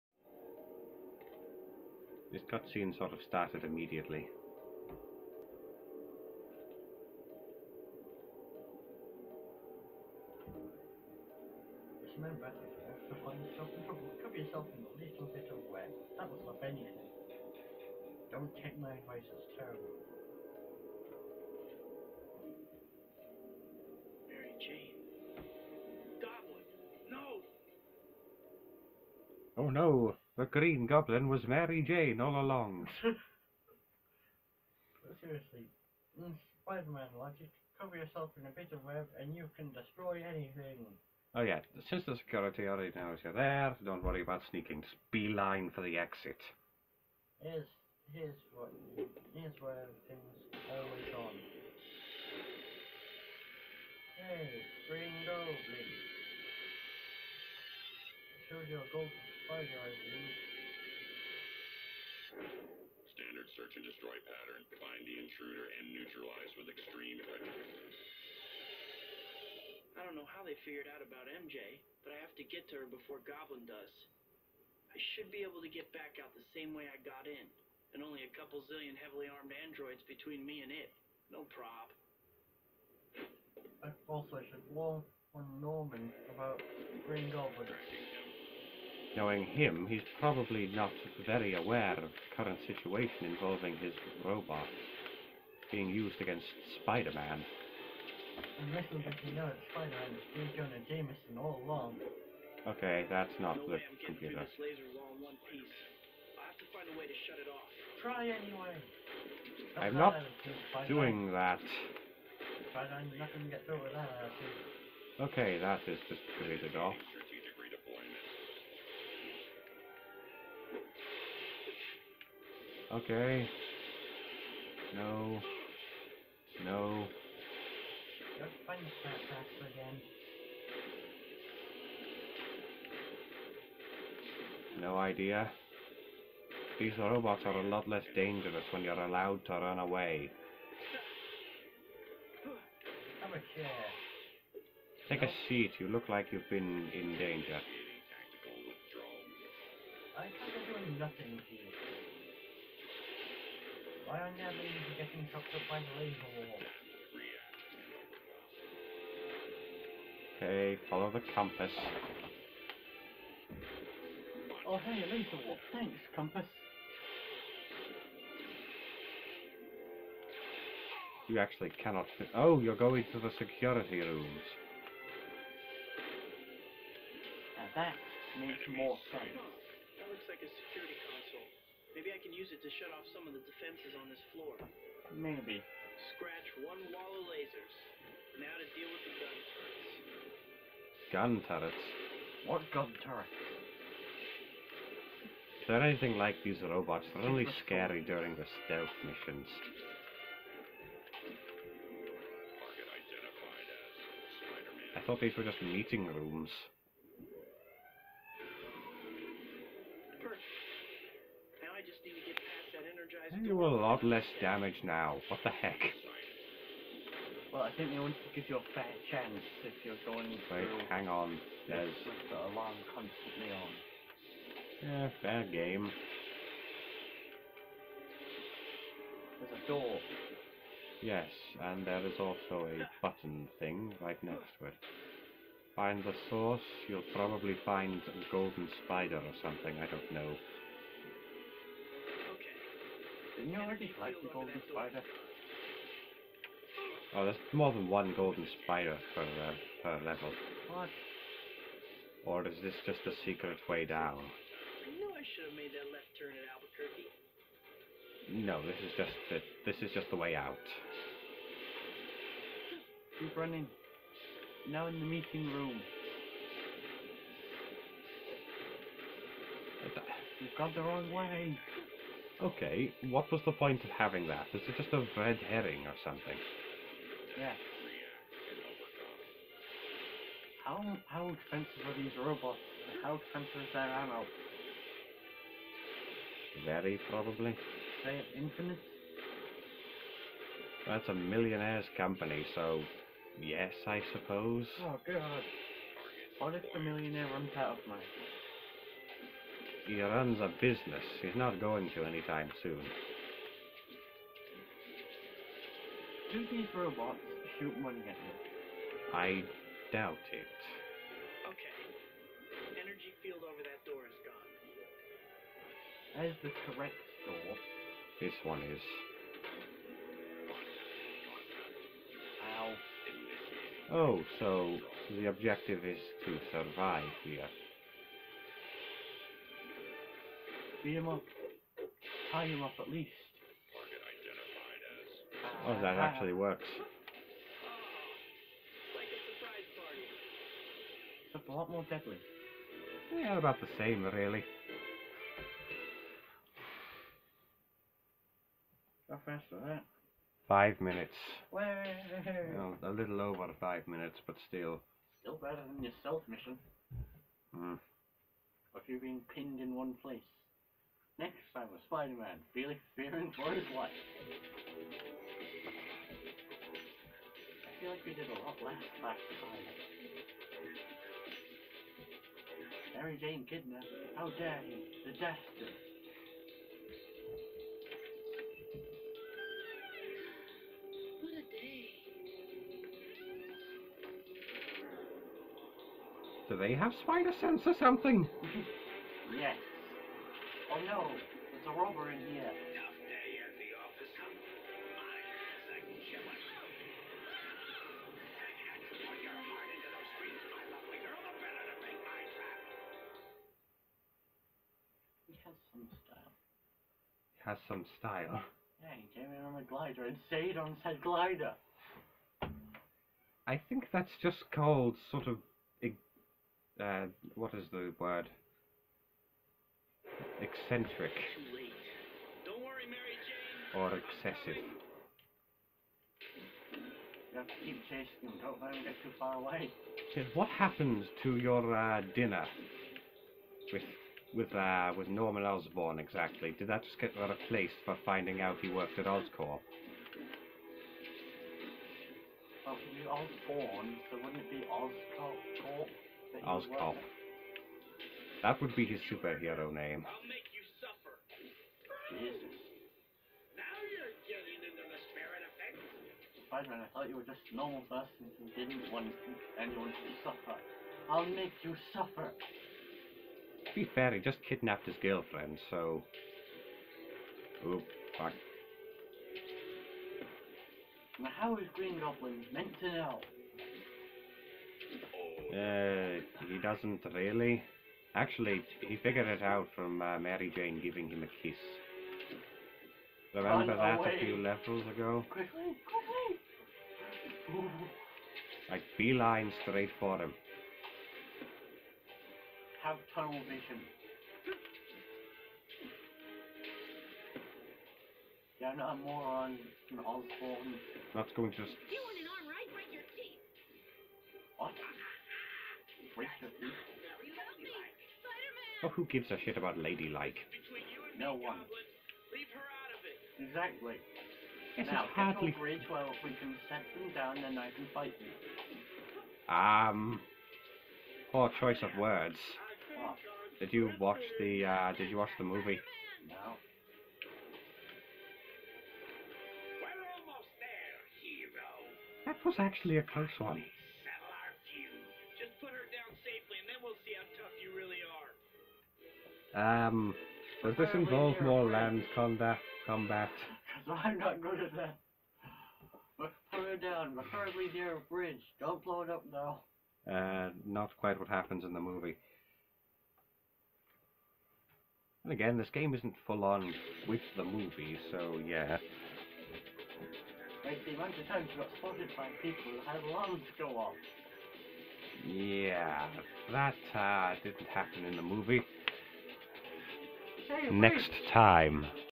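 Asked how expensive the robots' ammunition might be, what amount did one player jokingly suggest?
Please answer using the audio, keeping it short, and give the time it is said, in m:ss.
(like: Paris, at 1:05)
Infinite, at 4:48.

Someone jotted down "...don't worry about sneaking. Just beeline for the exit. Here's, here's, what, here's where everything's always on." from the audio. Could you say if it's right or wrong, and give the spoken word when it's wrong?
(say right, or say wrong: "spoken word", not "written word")
right.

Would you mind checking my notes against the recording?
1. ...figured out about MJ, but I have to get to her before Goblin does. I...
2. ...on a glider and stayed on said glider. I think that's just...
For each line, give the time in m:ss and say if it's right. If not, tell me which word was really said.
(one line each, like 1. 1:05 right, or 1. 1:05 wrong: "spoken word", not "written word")
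1. 1:10 right
2. 6:49 right.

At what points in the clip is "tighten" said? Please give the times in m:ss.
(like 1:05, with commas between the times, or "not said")
not said.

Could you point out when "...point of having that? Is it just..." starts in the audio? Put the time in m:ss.
4:33.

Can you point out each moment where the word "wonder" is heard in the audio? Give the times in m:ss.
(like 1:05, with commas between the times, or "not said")
not said.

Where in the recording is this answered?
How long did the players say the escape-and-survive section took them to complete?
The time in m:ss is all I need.
5:52.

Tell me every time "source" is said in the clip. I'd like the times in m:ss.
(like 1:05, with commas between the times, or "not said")
3:56.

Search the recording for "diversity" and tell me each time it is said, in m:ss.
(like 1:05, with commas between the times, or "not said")
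not said.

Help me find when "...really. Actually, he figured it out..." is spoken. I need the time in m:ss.
7:57.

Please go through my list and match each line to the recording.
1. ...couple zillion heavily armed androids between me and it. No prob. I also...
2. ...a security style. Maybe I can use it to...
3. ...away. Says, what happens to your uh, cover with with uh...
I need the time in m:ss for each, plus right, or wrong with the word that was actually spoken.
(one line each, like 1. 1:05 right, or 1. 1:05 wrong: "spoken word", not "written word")
1. 1:18 right
2. 3:00 wrong: "console", not "style"
3. 7:09 wrong: "dinner", not "cover".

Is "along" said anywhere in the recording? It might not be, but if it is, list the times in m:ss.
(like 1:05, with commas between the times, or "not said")
0:32, 1:41.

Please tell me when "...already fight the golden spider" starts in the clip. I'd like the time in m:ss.
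4:03.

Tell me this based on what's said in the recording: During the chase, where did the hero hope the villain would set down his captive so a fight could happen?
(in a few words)
Near a bridge.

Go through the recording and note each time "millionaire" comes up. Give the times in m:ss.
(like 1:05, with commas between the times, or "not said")
4:51, 4:56.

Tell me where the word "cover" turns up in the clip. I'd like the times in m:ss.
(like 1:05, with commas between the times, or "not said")
0:14, 0:37.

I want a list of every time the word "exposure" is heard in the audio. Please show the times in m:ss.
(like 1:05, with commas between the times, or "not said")
not said.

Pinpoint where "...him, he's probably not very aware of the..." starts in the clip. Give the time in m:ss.
1:29.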